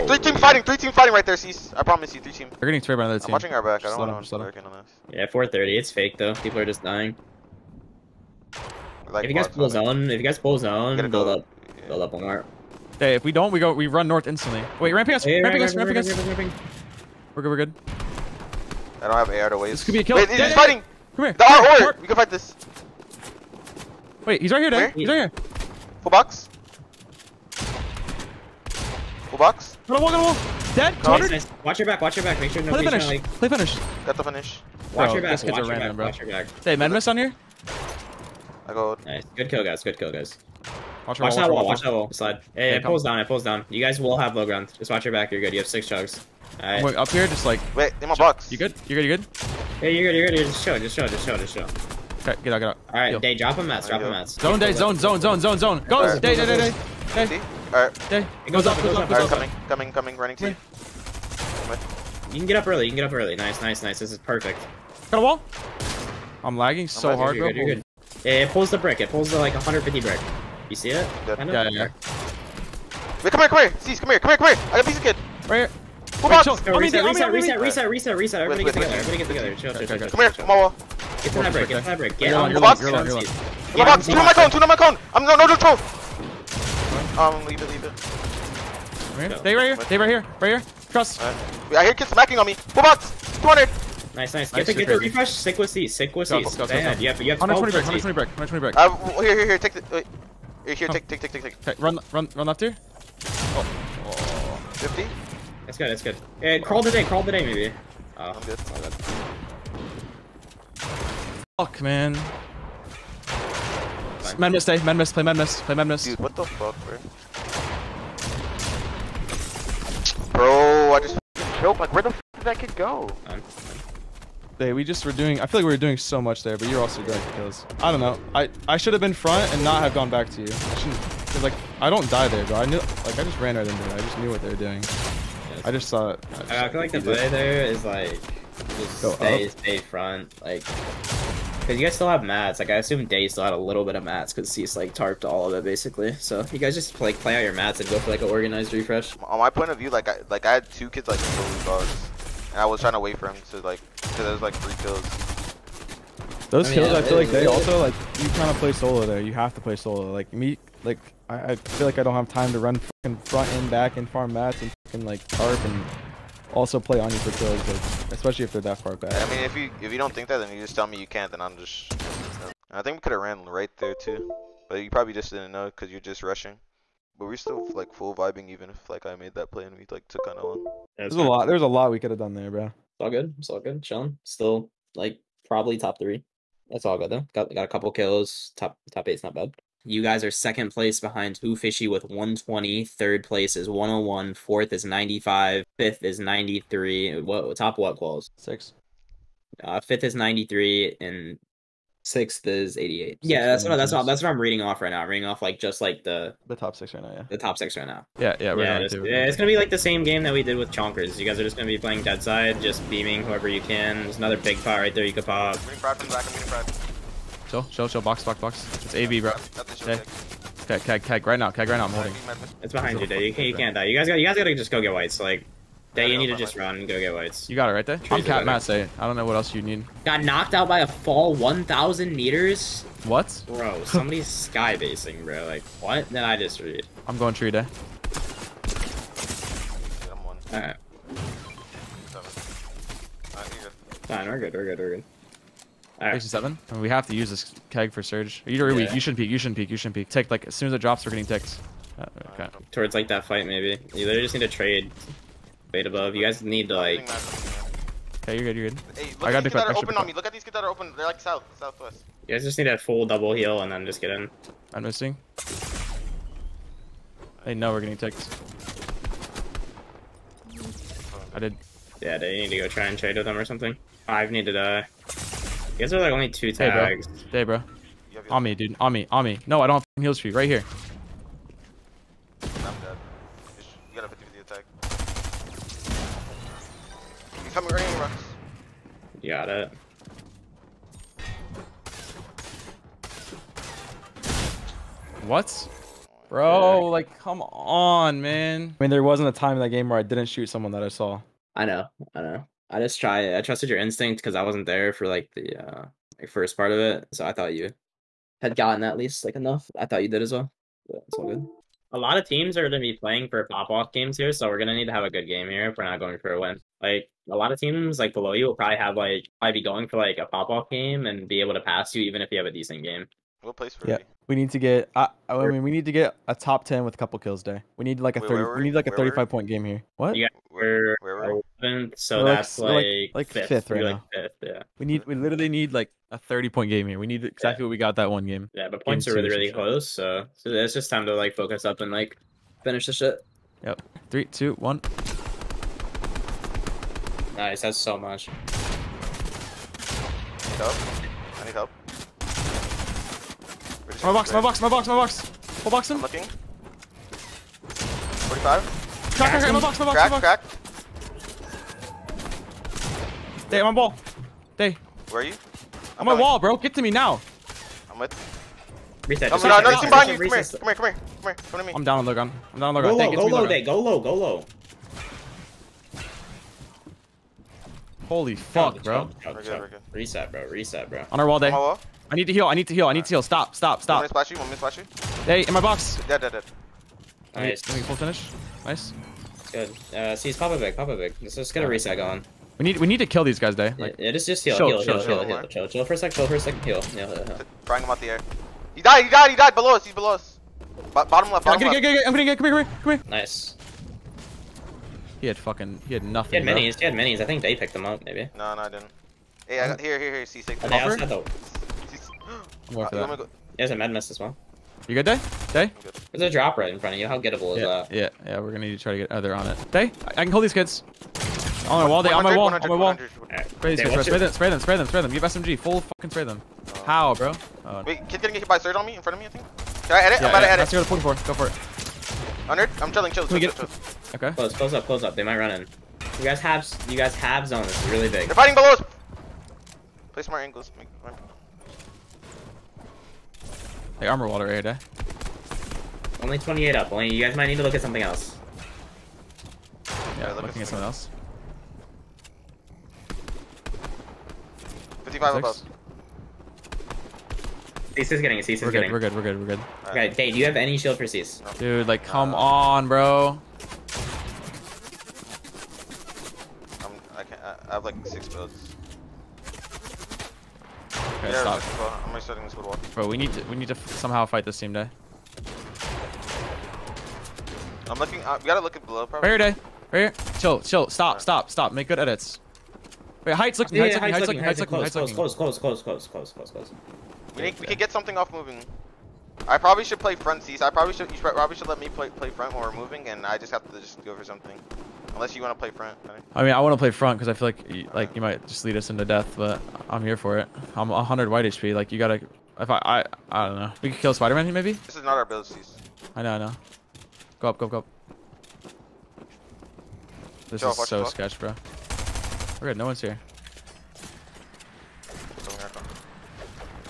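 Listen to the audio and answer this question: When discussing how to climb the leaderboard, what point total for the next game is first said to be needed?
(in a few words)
35.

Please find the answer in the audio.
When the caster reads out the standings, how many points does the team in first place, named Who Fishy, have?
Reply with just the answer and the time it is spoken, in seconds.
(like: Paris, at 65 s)
120, at 191 s.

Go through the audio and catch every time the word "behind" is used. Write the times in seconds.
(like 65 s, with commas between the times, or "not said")
190 s, 222 s, 369 s.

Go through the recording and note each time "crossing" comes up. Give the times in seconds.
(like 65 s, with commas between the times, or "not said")
not said.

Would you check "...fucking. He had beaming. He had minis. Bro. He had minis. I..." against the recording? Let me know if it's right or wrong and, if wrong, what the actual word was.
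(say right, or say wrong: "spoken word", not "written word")
wrong: "nothing", not "beaming".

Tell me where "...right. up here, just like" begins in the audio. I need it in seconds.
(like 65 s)
46 s.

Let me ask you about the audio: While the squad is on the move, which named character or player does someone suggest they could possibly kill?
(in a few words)
Spider-Man.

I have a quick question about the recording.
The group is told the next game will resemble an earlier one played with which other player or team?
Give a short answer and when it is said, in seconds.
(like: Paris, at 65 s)
Chonkers, at 209 s.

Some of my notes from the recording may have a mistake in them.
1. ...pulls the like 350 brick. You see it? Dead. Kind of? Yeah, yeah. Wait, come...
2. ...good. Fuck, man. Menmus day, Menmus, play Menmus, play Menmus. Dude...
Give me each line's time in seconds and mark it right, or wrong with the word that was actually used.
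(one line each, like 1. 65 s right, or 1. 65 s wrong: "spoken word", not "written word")
1. 69 s wrong: "150", not "350"
2. 108 s right.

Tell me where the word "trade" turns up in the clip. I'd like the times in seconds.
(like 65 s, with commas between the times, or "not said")
254 s, 272 s.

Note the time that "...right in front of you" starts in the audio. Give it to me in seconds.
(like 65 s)
416 s.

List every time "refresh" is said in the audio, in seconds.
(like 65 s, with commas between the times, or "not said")
94 s, 148 s.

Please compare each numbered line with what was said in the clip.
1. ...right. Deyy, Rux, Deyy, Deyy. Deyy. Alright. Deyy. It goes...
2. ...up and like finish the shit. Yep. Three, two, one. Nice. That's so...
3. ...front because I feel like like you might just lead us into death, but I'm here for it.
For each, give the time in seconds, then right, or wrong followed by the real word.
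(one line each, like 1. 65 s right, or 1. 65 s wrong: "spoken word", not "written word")
1. 56 s wrong: "Deyy", not "Rux"
2. 341 s right
3. 496 s right.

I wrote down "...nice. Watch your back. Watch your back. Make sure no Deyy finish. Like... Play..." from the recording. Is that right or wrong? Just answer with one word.
wrong.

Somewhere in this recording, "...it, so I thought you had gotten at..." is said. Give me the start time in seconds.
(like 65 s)
306 s.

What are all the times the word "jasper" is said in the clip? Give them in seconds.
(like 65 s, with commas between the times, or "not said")
not said.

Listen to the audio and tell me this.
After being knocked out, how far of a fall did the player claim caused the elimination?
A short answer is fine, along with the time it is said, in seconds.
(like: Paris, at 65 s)
1,000 meters, at 230 s.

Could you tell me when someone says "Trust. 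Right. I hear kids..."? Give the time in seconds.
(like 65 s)
90 s.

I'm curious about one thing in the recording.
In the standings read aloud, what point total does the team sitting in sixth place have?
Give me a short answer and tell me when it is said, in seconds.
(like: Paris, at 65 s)
88, at 202 s.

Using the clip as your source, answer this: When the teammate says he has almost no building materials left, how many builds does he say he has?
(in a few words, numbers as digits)
6.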